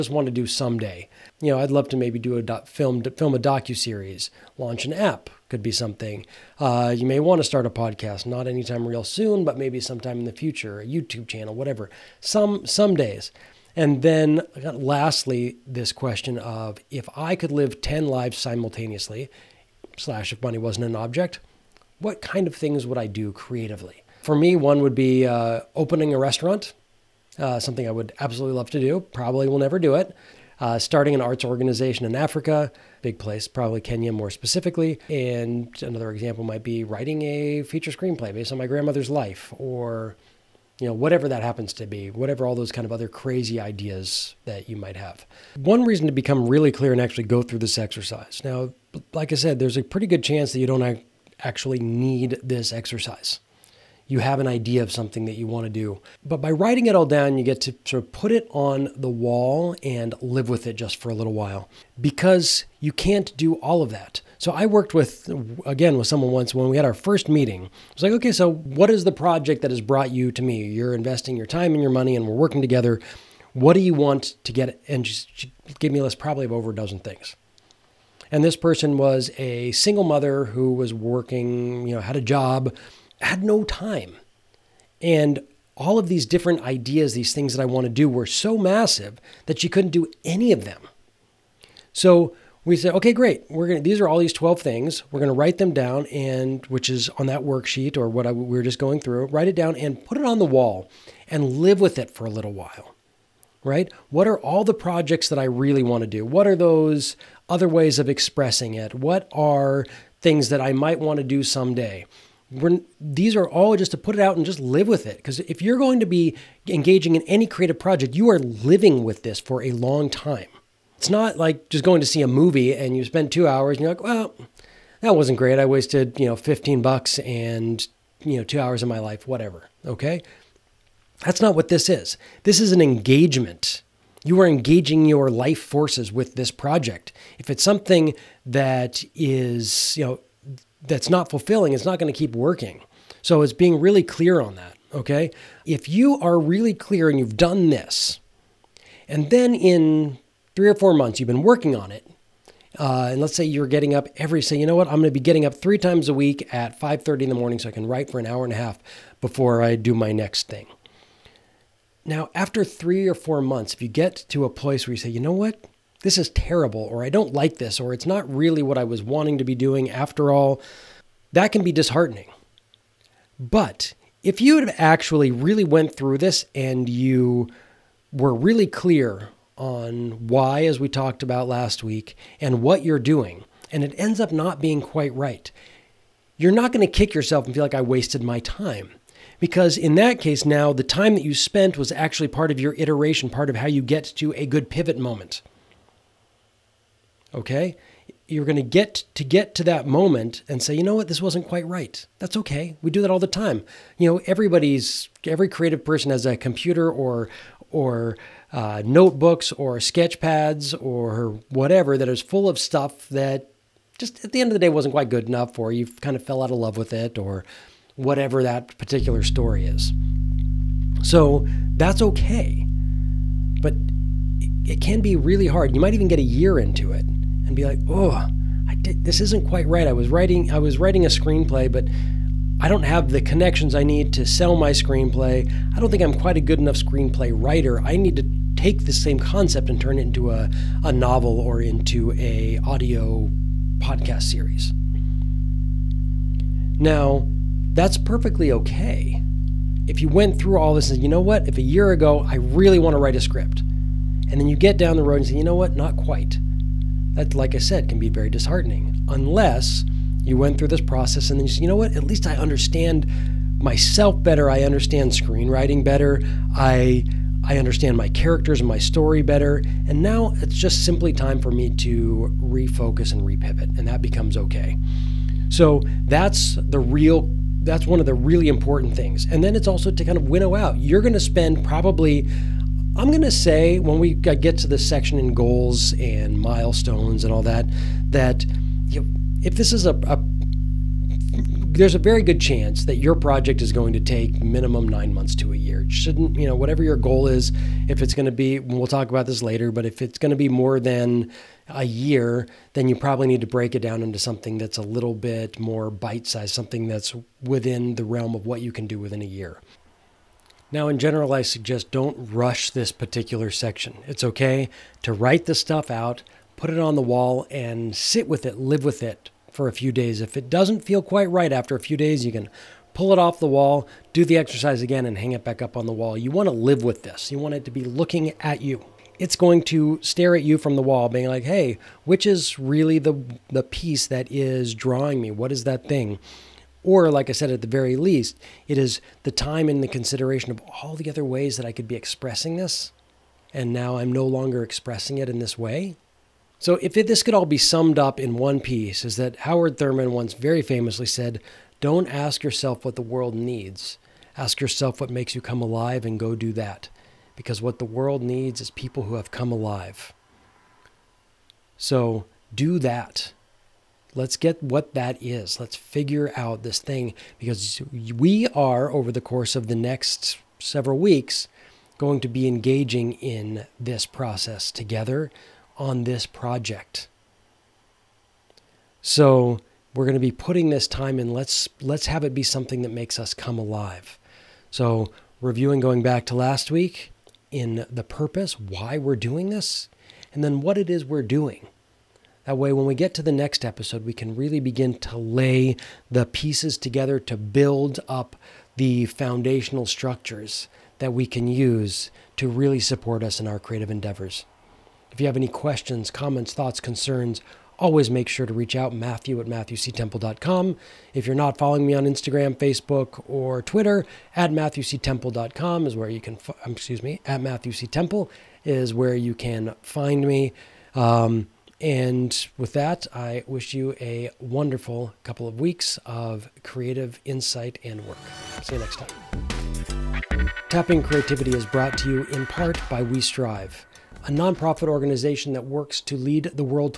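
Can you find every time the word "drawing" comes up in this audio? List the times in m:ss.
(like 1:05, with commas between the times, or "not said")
5:34.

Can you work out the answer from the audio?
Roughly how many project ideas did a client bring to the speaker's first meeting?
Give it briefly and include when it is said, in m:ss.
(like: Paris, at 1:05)
Over a dozen, at 1:16.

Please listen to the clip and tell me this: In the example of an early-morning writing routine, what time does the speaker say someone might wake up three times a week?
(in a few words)
5:30.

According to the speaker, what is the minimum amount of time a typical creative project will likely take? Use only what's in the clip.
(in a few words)
9 months.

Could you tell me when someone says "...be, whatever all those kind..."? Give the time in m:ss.
0:41.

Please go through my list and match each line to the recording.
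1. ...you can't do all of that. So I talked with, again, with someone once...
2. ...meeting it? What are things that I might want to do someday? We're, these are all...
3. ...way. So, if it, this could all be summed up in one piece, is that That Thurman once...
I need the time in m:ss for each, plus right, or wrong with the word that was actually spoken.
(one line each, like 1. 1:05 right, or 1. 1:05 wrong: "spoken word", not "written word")
1. 1:02 wrong: "worked", not "talked"
2. 1:48 wrong: "expressing", not "meeting"
3. 5:45 wrong: "Howard", not "That".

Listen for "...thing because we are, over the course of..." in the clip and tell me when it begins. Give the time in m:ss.
6:06.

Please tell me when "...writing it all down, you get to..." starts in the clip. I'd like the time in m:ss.
0:56.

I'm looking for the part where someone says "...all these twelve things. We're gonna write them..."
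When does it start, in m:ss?
1:34.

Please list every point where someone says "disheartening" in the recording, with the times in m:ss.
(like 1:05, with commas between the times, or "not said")
2:51, 4:18.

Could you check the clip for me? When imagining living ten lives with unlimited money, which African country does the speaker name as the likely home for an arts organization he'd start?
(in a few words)
Kenya.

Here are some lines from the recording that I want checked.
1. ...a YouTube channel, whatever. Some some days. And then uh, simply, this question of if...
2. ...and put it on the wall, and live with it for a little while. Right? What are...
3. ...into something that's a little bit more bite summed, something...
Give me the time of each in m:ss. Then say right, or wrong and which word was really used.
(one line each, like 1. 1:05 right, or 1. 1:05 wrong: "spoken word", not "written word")
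1. 0:10 wrong: "lastly", not "simply"
2. 1:39 right
3. 5:04 wrong: "sized", not "summed".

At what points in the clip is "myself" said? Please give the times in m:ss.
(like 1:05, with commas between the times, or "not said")
4:23.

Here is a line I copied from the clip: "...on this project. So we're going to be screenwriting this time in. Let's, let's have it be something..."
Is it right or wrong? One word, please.
wrong.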